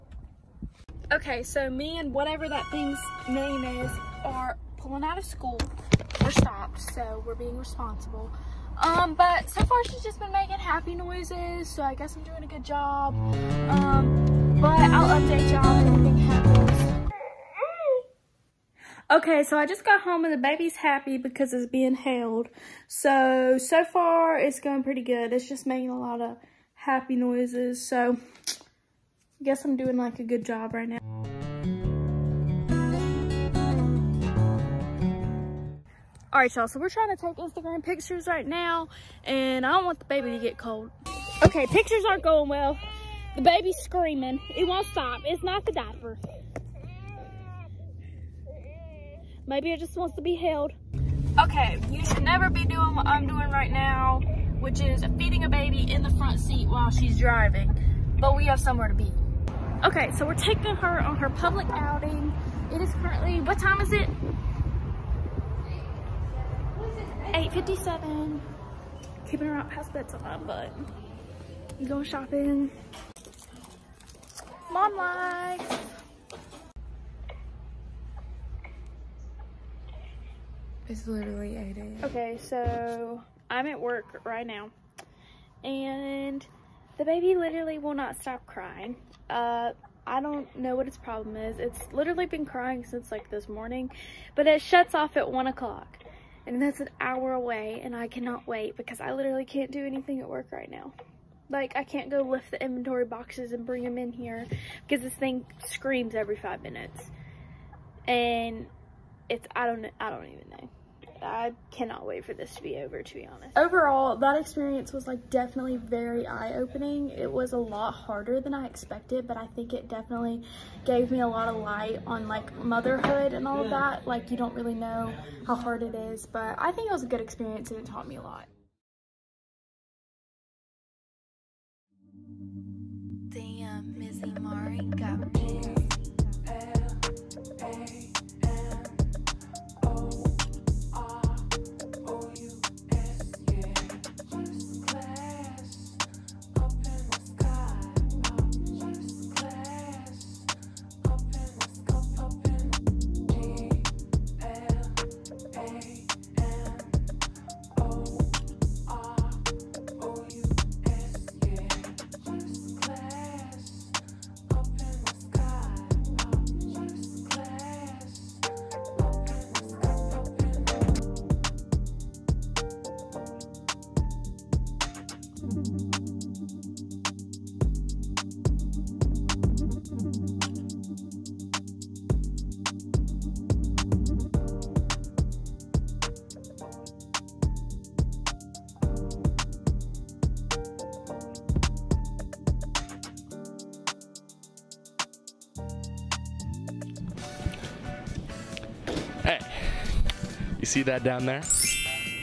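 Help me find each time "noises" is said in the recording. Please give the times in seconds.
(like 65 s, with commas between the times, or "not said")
10 s, 27 s.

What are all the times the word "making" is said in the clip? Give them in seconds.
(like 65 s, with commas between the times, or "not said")
10 s, 25 s.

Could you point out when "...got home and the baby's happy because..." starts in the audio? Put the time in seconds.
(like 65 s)
19 s.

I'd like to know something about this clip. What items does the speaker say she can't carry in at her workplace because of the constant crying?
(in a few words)
inventory boxes.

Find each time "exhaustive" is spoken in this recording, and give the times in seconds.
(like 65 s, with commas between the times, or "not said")
not said.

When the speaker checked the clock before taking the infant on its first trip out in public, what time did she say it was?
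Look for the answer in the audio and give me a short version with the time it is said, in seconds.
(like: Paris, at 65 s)
8:57, at 67 s.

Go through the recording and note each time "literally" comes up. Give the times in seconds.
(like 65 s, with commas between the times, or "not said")
81 s, 87 s, 91 s, 99 s.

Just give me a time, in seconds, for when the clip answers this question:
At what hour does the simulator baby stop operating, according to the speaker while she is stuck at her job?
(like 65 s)
95 s.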